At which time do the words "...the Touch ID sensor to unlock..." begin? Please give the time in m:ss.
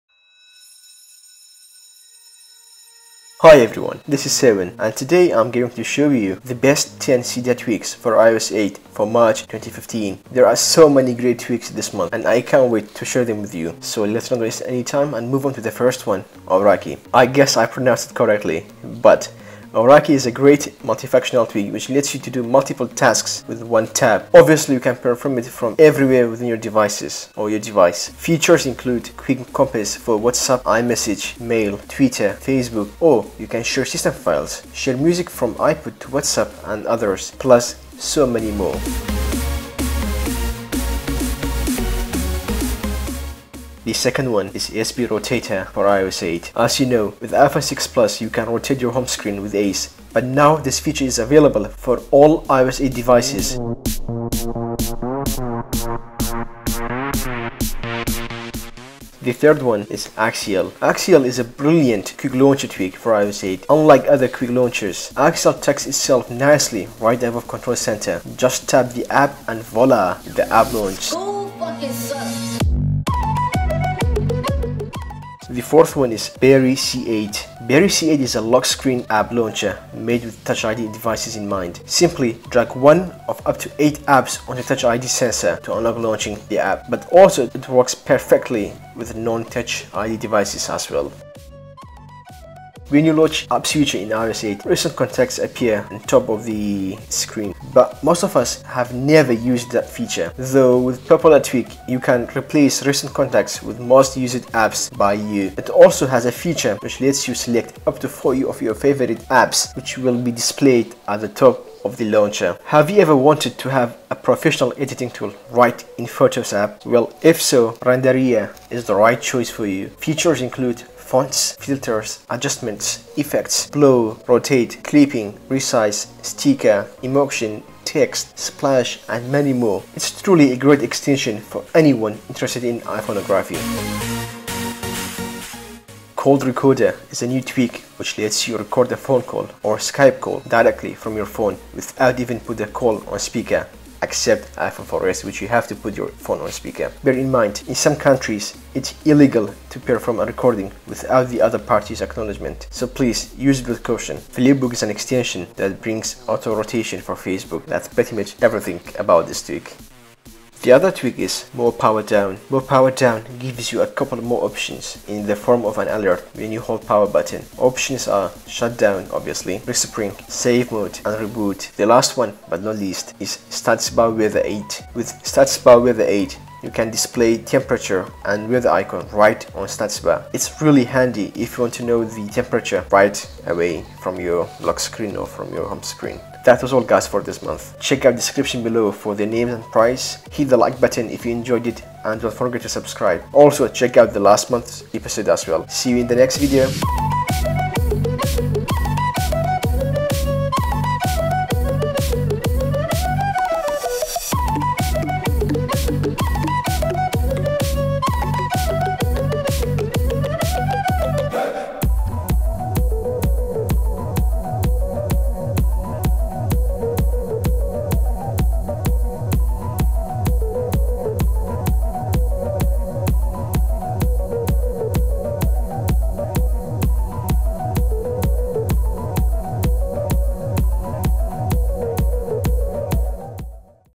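1:24.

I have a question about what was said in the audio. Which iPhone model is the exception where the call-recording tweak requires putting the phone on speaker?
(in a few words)
iPhone 4S.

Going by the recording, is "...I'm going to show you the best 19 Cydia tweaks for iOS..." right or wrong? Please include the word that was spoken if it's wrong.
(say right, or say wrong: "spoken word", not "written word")
wrong: "10", not "19".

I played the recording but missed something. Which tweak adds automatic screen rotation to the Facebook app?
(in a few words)
Flipbook.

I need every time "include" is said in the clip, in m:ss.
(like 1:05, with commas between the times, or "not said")
0:28, 2:00.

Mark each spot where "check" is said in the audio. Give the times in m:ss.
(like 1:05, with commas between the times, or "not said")
3:07, 3:13.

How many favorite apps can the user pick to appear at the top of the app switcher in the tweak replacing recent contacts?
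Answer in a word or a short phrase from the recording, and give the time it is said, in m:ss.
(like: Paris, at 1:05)
40, at 1:48.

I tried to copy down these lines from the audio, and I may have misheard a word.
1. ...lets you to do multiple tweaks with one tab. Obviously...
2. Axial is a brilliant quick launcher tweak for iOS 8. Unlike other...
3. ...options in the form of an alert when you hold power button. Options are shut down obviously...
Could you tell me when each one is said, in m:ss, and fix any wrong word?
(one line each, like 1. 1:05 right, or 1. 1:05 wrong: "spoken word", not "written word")
1. 0:21 wrong: "tasks", not "tweaks"
2. 1:00 right
3. 2:44 right.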